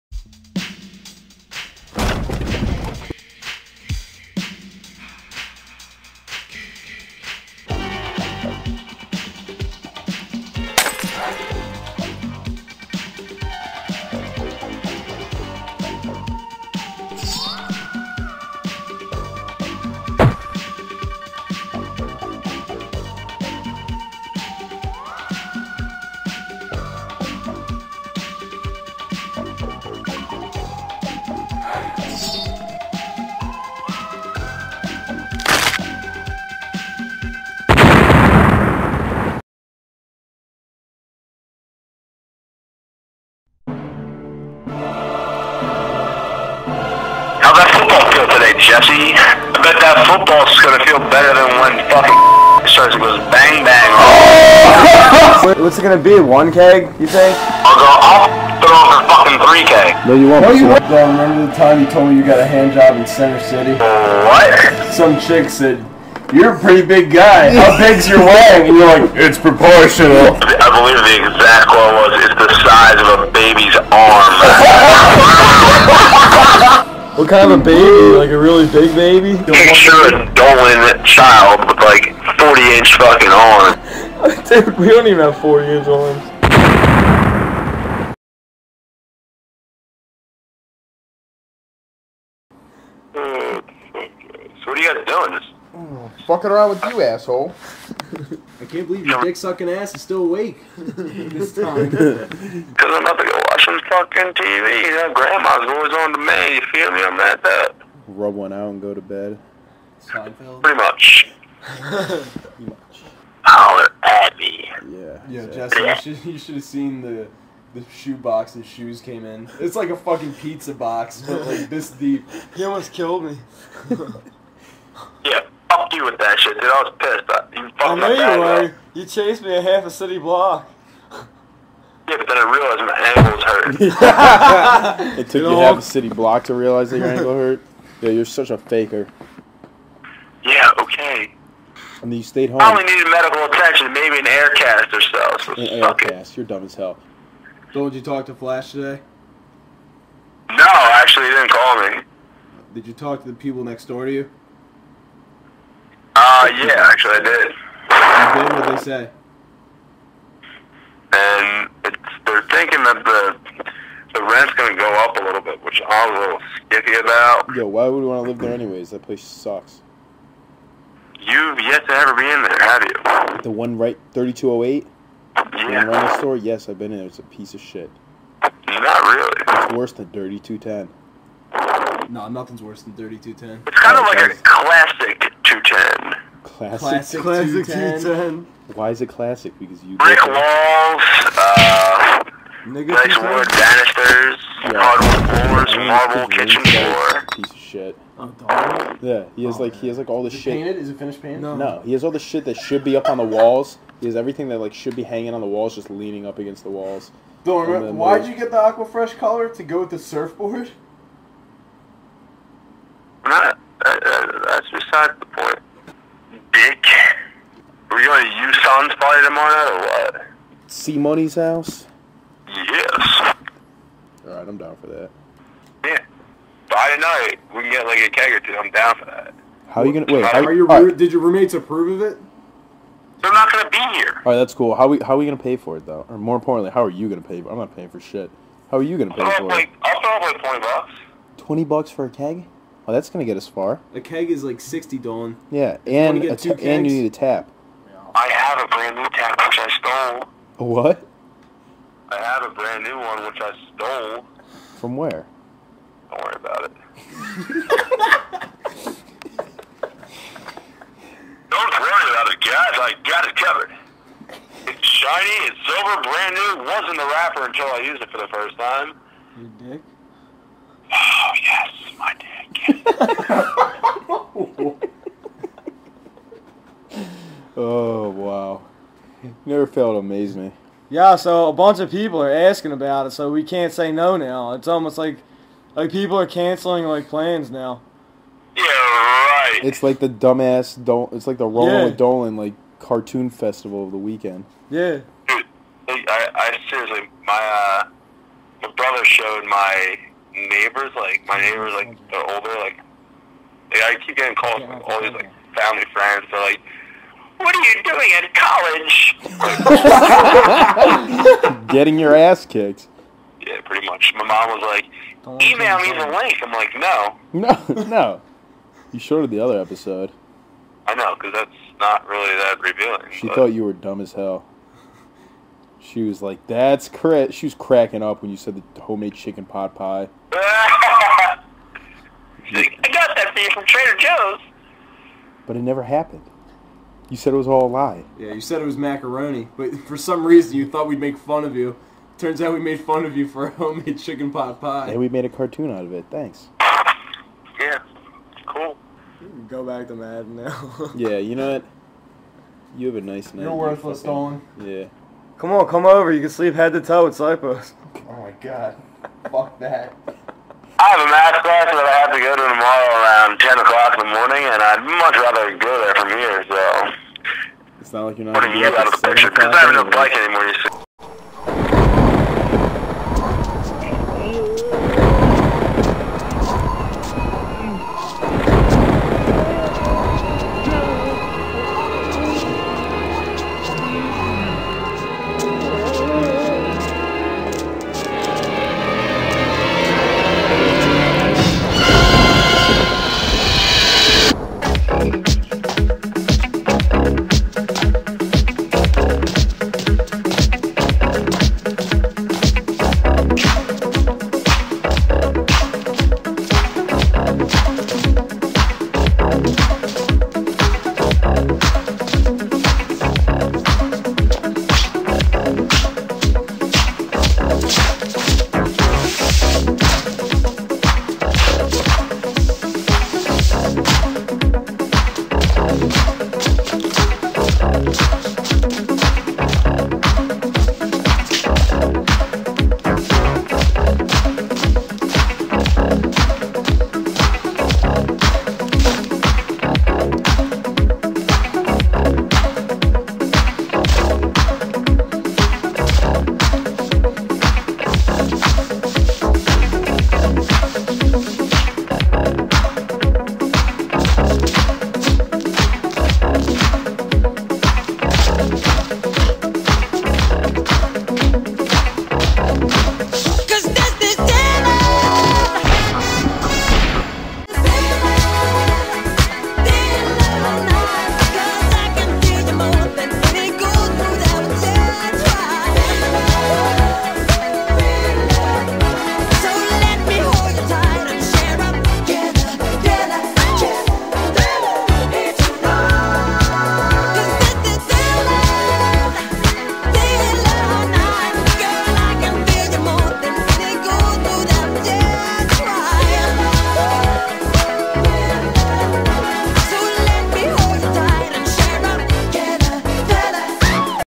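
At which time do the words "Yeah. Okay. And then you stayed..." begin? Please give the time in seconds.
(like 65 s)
140 s.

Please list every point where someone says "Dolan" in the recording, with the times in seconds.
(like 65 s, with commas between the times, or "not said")
80 s, 244 s, 291 s, 354 s.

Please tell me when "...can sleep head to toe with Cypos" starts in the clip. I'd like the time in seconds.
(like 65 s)
356 s.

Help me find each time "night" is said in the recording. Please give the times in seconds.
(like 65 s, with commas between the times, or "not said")
219 s, 353 s.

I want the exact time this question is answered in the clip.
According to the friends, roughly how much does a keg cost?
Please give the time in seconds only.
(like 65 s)
244 s.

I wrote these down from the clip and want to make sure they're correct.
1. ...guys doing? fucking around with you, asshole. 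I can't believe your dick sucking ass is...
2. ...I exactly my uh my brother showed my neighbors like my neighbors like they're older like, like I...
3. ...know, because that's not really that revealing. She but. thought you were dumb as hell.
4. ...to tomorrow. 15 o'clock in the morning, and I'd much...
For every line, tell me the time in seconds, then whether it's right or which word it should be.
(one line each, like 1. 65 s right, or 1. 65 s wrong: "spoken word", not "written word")
1. 95 s right
2. 296 s wrong: "seriously", not "exactly"
3. 320 s right
4. 362 s wrong: "10", not "15".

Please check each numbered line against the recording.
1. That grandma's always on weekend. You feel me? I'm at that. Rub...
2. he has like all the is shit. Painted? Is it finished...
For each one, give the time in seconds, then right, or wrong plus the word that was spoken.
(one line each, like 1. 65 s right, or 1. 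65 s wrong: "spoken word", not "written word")
1. 104 s wrong: "demand", not "weekend"
2. 199 s right.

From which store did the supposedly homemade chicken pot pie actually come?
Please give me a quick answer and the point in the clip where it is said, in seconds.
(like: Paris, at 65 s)
Trader Joe's, at 333 s.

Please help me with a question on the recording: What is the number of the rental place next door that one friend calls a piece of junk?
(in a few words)
3208.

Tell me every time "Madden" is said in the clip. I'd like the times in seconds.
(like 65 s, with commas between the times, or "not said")
349 s.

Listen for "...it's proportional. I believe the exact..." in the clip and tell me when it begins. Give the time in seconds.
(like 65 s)
69 s.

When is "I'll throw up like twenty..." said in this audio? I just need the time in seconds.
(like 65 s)
239 s.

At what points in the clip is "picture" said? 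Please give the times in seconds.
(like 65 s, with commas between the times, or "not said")
79 s, 369 s.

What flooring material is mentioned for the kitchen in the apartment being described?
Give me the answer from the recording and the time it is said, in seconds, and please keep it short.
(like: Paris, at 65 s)
Marble, at 195 s.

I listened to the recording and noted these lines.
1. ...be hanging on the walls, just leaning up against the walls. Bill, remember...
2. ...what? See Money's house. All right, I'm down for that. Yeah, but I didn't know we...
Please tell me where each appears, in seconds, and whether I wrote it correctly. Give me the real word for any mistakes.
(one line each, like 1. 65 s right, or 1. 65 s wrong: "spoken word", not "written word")
1. 204 s right
2. 220 s right.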